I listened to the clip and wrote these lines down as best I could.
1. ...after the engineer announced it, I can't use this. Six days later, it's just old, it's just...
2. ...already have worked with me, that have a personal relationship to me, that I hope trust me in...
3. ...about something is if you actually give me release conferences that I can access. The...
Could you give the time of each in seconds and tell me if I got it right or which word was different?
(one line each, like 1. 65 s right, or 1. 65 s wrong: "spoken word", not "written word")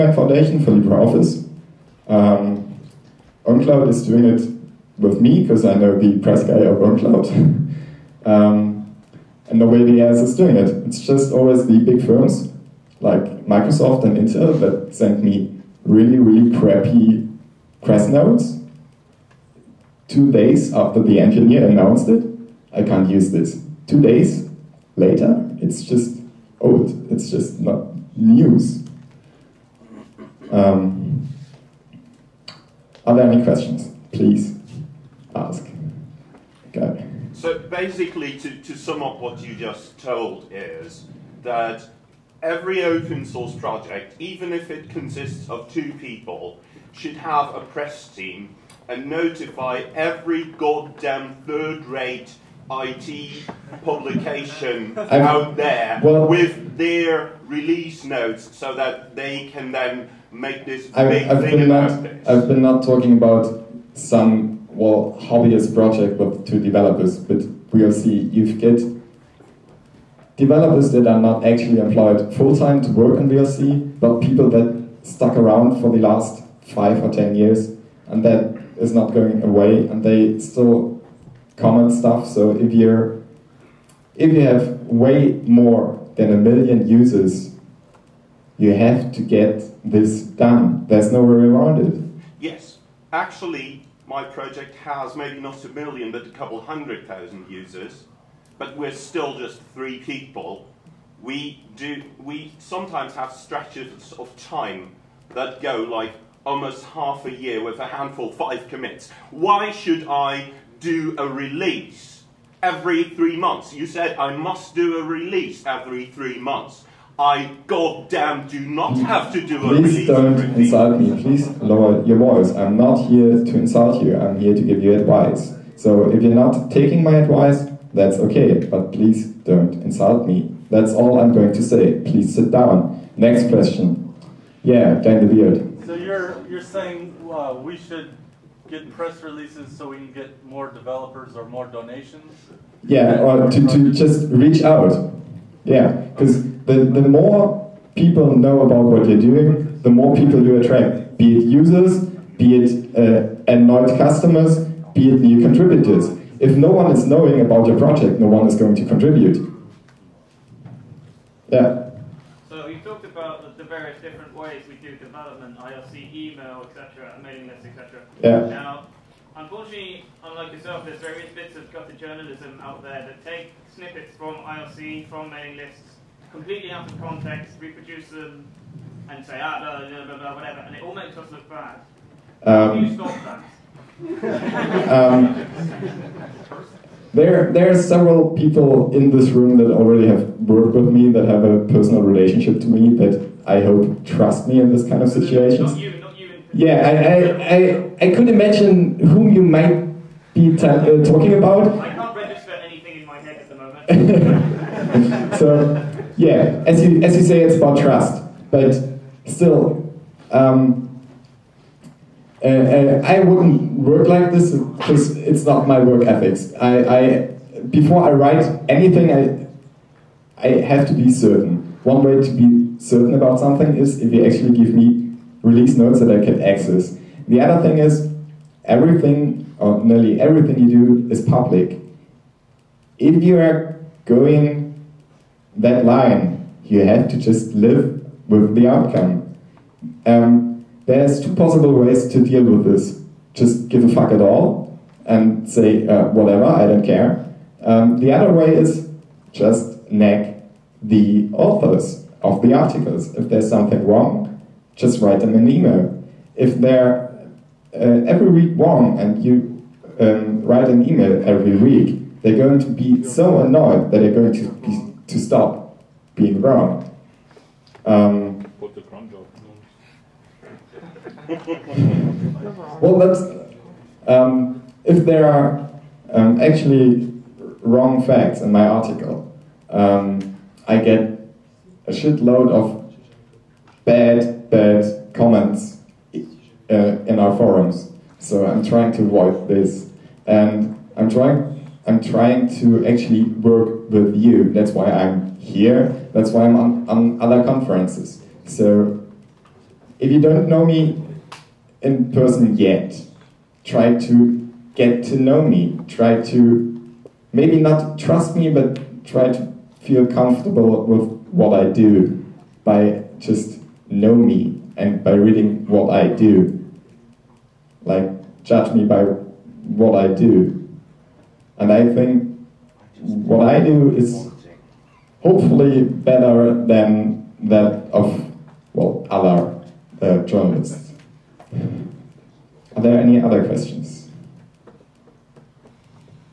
1. 20 s wrong: "Two", not "Six"
2. 189 s right
3. 223 s wrong: "notes", not "conferences".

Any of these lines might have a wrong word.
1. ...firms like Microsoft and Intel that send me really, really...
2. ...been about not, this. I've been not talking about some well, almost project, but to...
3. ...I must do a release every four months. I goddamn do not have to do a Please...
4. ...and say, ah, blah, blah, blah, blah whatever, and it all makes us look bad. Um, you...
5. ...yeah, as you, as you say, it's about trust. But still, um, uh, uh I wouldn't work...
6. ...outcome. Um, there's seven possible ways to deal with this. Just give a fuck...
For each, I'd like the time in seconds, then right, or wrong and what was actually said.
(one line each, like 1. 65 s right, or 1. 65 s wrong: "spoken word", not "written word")
1. 12 s right
2. 61 s wrong: "hobbyist", not "almost"
3. 114 s wrong: "three", not "four"
4. 179 s right
5. 206 s right
6. 238 s wrong: "two", not "seven".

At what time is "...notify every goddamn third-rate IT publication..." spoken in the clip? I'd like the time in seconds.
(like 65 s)
49 s.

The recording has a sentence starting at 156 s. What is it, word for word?
If no one is knowing about your project, no one is going to contribute.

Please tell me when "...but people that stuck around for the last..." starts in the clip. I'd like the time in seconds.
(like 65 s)
73 s.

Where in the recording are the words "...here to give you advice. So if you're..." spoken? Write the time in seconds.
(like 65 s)
124 s.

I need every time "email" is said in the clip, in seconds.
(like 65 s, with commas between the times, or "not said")
166 s, 255 s, 260 s.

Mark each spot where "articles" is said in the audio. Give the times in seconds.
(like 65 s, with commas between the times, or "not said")
252 s, 278 s.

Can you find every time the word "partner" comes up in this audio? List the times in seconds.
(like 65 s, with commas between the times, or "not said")
not said.